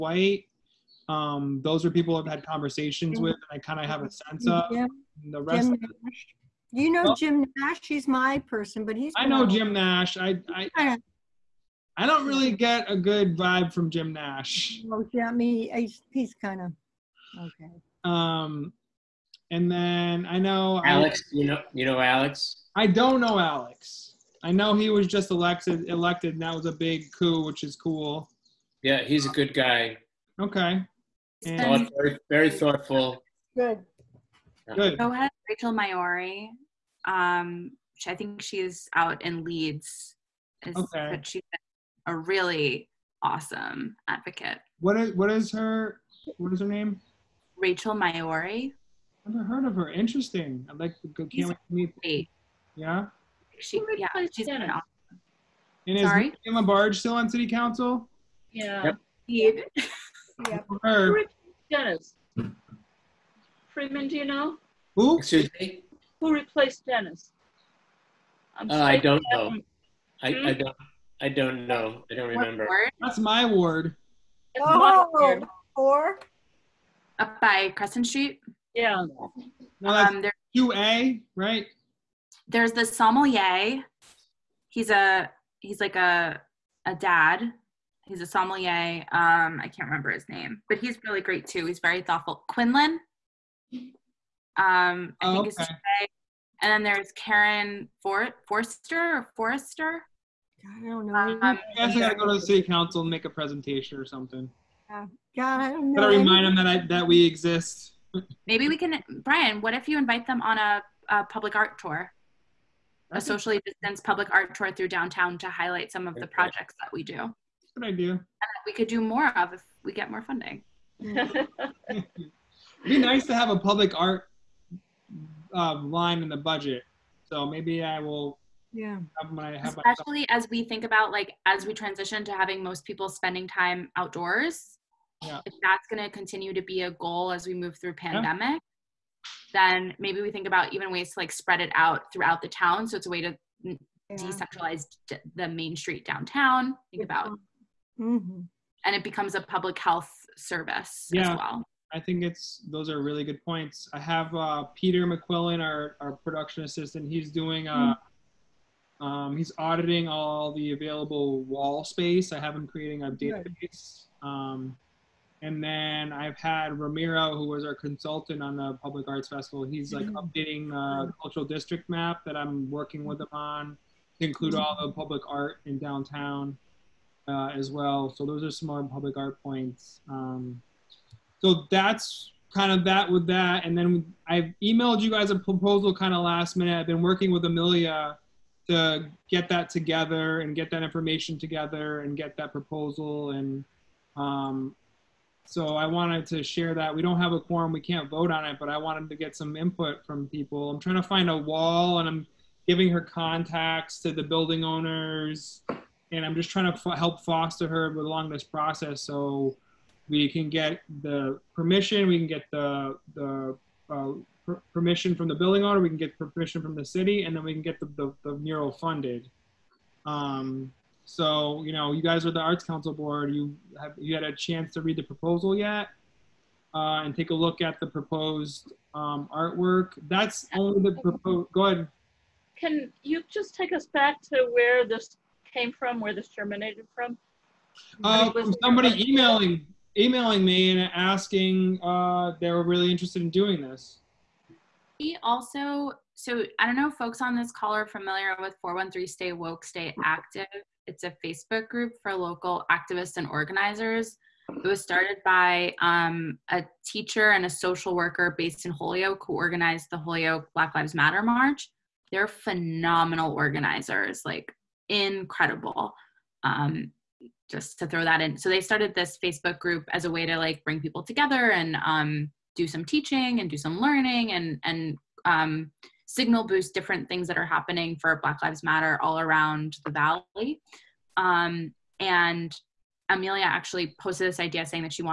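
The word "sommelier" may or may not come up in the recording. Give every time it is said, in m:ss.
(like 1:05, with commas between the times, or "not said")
1:22, 1:28.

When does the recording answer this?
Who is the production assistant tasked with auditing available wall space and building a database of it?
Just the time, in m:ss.
2:34.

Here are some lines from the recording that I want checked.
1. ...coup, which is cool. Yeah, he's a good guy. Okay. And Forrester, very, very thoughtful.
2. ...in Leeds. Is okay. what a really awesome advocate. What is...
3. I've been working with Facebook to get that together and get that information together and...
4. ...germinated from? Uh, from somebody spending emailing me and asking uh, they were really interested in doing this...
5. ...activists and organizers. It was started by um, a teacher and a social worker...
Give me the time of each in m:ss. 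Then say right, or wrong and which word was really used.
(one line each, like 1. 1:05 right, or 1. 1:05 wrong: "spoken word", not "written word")
1. 0:27 wrong: "Thought", not "Forrester"
2. 0:39 right
3. 3:06 wrong: "Amelia", not "Facebook"
4. 3:56 wrong: "emailing", not "spending"
5. 4:12 right.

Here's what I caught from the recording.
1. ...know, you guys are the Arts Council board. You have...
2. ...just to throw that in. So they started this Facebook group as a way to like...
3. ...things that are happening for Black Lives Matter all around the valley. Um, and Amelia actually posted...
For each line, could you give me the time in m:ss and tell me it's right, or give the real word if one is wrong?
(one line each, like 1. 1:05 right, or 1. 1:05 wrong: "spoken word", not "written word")
1. 3:41 right
2. 4:27 right
3. 4:37 right.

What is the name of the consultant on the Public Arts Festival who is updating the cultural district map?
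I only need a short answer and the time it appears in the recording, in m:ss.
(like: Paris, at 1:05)
Ramiro, at 2:46.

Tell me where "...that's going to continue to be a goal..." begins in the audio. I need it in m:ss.
2:15.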